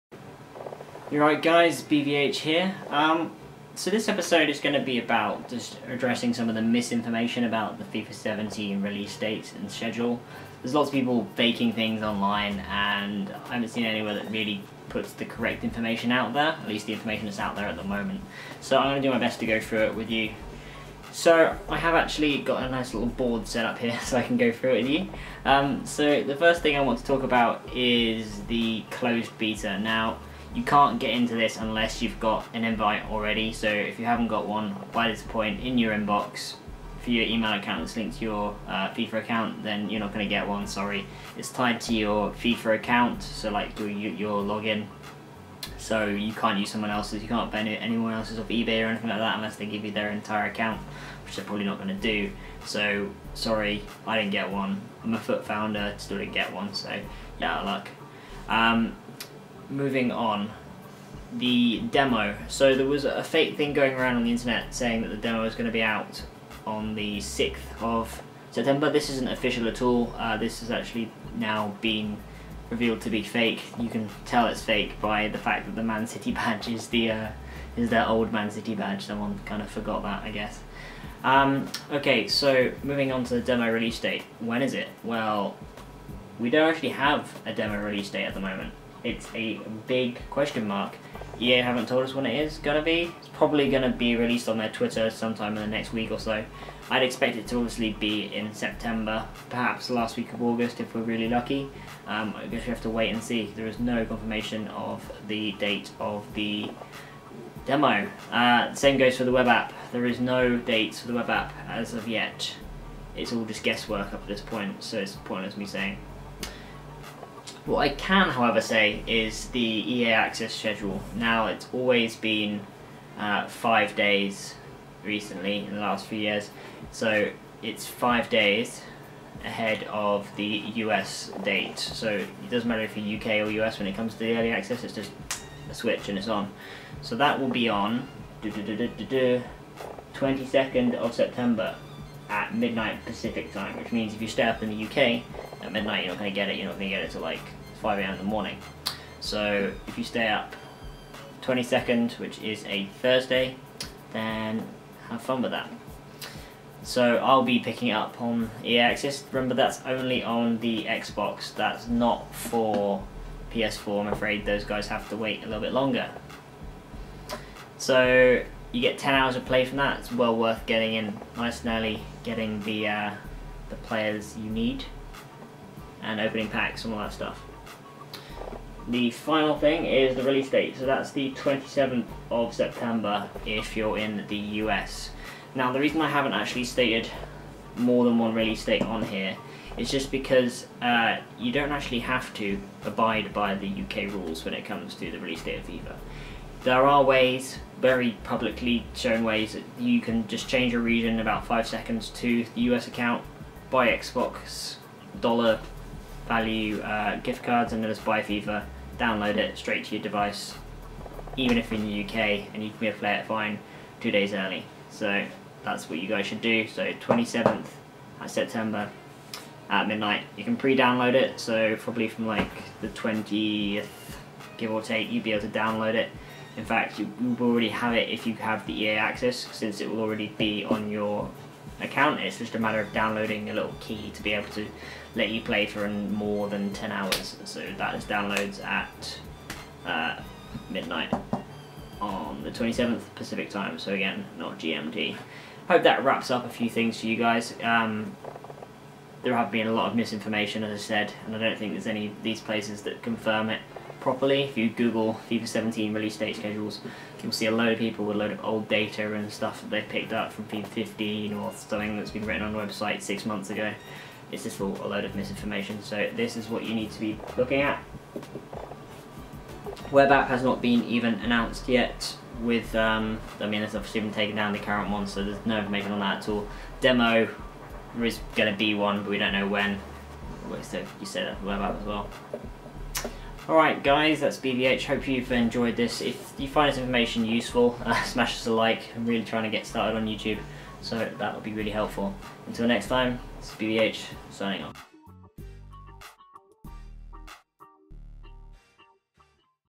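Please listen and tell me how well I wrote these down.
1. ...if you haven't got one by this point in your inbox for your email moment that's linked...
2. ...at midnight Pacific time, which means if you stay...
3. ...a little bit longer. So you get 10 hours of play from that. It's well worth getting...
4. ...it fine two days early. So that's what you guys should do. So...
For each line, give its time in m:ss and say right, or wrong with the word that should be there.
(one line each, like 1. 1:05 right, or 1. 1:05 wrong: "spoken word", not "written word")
1. 0:33 wrong: "account", not "moment"
2. 2:22 right
3. 2:45 right
4. 3:33 right.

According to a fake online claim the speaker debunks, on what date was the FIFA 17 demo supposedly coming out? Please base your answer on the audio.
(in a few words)
6th of September.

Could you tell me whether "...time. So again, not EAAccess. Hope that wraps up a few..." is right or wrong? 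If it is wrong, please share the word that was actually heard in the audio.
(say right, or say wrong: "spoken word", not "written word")
wrong: "GMT", not "EAAccess".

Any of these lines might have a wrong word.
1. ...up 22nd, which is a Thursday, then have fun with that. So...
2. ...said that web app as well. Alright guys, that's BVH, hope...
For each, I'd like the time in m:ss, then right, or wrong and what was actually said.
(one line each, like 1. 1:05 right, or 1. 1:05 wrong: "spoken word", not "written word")
1. 2:30 right
2. 4:41 right.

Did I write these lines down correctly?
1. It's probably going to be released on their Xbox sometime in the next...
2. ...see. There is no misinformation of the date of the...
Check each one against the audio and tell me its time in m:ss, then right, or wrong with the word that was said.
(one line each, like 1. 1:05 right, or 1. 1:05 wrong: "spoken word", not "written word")
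1. 1:33 wrong: "Twitter", not "Xbox"
2. 1:43 wrong: "confirmation", not "misinformation".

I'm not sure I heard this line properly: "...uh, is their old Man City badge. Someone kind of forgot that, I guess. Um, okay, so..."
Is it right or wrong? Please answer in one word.
right.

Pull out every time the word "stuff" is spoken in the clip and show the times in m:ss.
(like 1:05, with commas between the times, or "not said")
2:57, 4:19.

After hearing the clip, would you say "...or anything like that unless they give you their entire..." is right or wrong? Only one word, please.
right.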